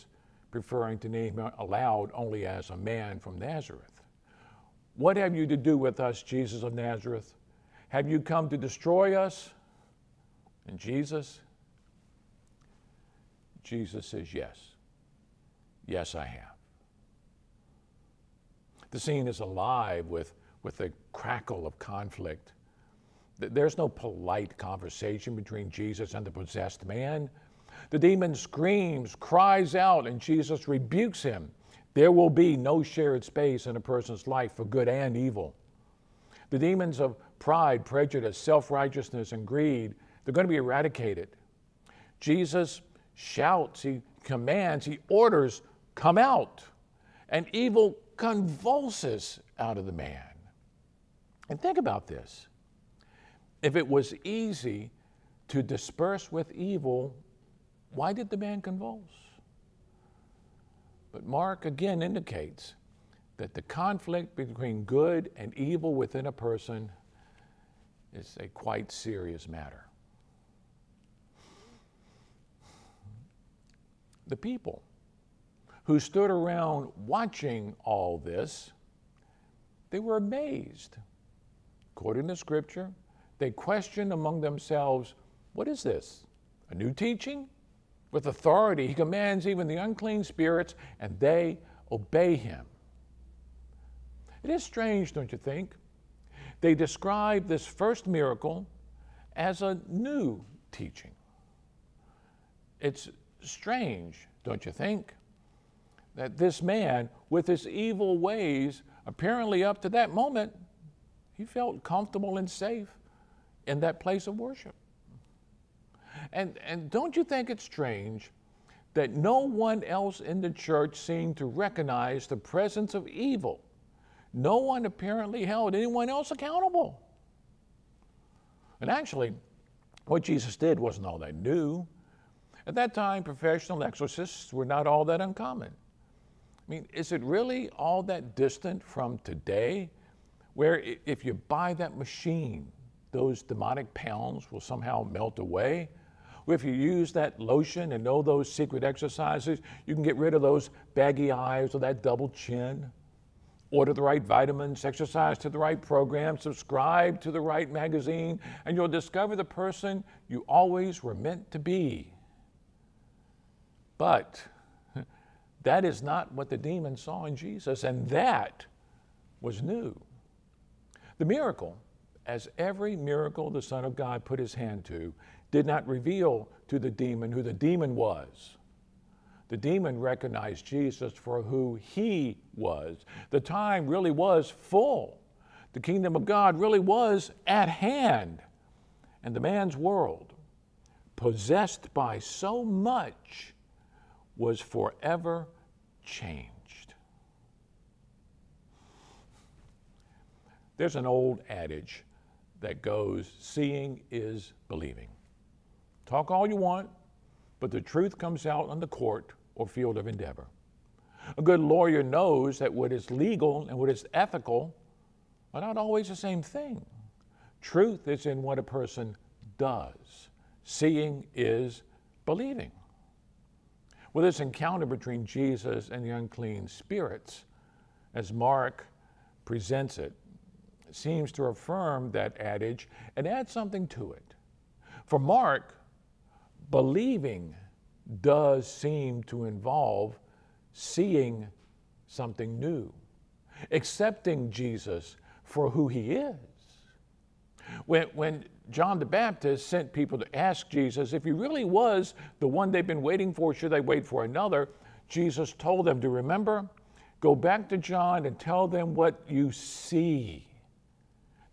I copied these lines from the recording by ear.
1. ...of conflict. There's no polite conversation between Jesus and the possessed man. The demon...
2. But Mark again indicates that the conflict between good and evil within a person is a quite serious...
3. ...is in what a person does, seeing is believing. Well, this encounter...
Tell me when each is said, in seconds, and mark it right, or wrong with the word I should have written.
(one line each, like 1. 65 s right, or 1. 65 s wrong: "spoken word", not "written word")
1. 21 s right
2. 61 s right
3. 218 s right.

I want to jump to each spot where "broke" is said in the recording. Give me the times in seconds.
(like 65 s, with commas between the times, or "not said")
not said.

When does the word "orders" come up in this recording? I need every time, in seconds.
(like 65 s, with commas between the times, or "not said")
45 s, 153 s.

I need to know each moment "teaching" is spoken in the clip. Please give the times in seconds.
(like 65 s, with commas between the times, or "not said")
86 s, 100 s.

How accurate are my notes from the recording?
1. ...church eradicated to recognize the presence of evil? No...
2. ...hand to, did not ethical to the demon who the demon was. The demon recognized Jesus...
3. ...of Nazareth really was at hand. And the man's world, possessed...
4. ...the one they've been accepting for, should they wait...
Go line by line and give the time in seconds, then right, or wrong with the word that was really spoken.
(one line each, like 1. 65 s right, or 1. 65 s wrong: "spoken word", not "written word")
1. 120 s wrong: "seemed", not "eradicated"
2. 174 s wrong: "reveal", not "ethical"
3. 186 s wrong: "God", not "Nazareth"
4. 252 s wrong: "waiting", not "accepting".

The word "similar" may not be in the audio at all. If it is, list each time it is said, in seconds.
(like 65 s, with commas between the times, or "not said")
not said.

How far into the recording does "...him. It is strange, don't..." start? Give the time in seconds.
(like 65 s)
92 s.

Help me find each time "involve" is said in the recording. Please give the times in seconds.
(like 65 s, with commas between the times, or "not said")
239 s.